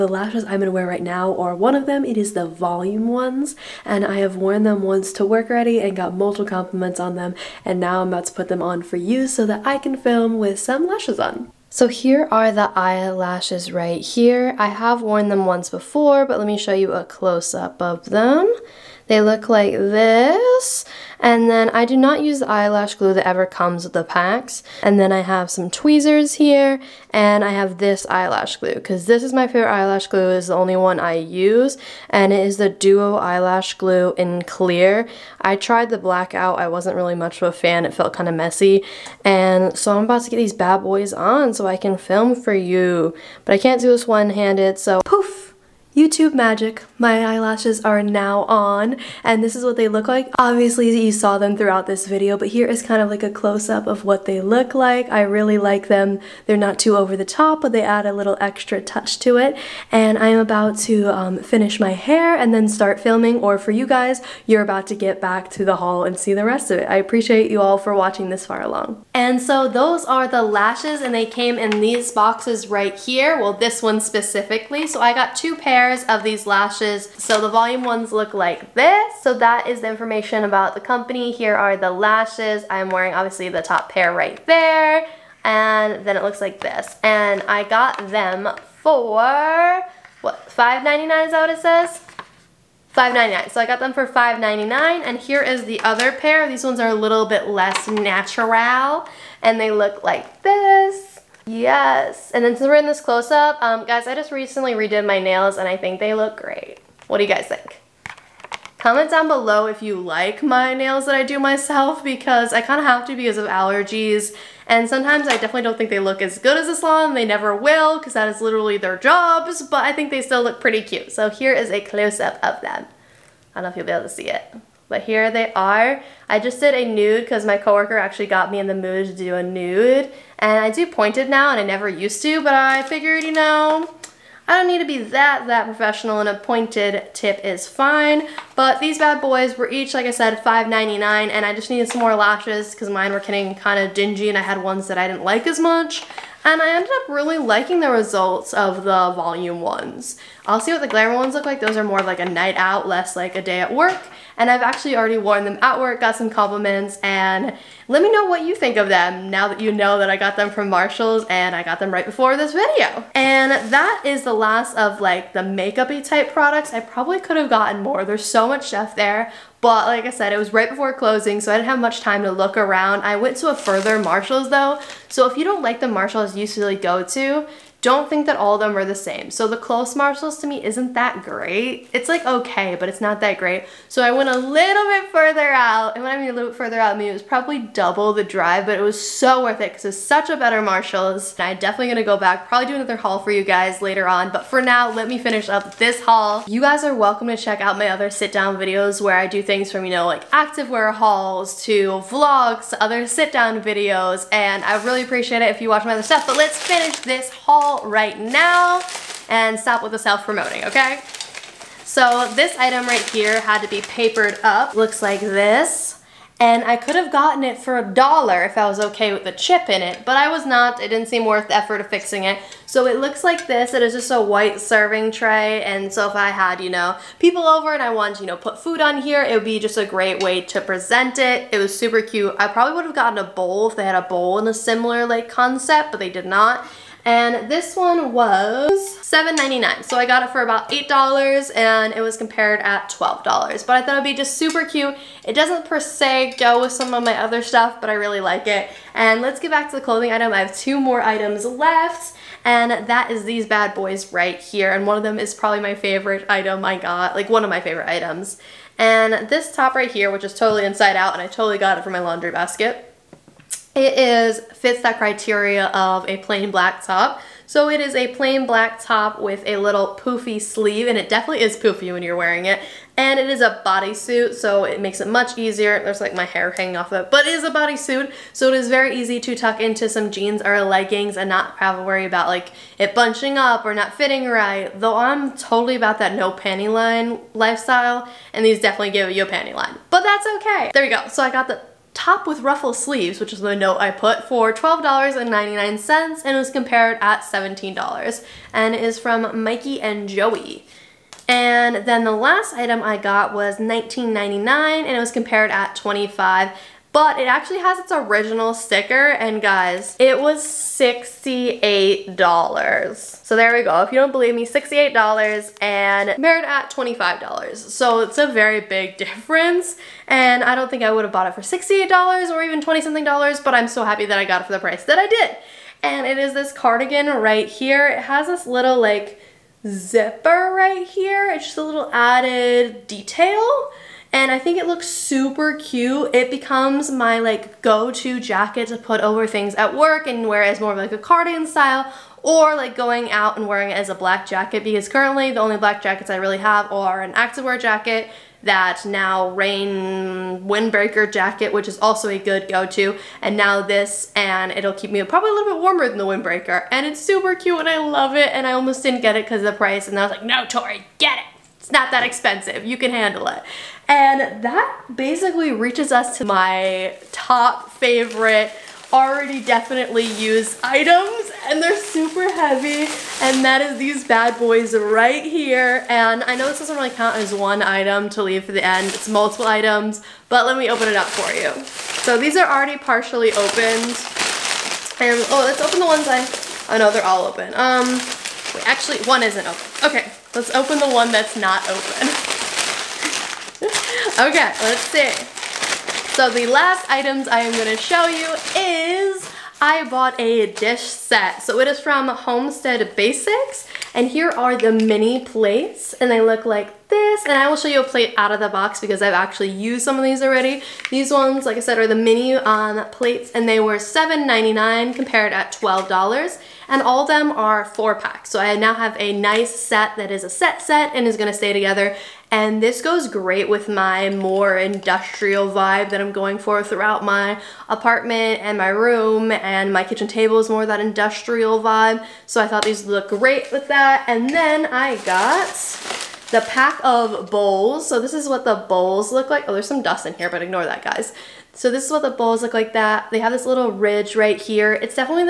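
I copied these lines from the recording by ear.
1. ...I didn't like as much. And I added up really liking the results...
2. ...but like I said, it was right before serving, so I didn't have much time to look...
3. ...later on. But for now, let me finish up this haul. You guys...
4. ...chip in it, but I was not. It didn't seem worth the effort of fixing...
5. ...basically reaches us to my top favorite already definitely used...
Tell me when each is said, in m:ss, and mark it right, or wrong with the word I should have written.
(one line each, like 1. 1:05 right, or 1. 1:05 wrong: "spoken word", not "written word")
1. 2:24 wrong: "ended", not "added"
2. 2:49 wrong: "closing", not "serving"
3. 3:13 right
4. 3:39 right
5. 6:04 right.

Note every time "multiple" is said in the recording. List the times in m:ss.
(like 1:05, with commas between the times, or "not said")
0:06, 6:19.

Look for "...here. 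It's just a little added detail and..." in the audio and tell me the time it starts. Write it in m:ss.
5:30.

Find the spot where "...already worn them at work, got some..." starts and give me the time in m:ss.
2:34.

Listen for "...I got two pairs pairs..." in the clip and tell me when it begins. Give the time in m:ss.
1:15.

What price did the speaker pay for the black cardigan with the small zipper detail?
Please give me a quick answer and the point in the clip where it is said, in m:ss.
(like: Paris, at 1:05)
$19.99, at 5:03.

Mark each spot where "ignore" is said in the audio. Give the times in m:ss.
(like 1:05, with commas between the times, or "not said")
7:20.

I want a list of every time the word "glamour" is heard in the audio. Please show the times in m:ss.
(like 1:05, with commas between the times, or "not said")
2:30.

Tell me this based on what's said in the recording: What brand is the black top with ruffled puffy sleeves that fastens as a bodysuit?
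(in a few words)
Mikey and Joey.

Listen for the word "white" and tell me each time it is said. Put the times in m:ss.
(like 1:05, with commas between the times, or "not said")
3:44.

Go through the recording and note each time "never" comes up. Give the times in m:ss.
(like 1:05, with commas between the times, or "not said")
1:57, 2:11.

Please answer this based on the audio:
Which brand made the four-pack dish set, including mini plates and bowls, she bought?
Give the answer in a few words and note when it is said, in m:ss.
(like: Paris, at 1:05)
Homestead Basics, at 6:42.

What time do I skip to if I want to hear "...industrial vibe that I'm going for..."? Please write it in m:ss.
7:04.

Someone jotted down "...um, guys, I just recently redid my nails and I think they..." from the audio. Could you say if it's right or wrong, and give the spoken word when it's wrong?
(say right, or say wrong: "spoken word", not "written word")
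right.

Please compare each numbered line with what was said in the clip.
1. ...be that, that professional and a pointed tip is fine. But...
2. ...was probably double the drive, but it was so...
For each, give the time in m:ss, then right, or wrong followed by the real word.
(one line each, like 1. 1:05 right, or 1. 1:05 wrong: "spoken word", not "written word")
1. 2:14 right
2. 3:07 right.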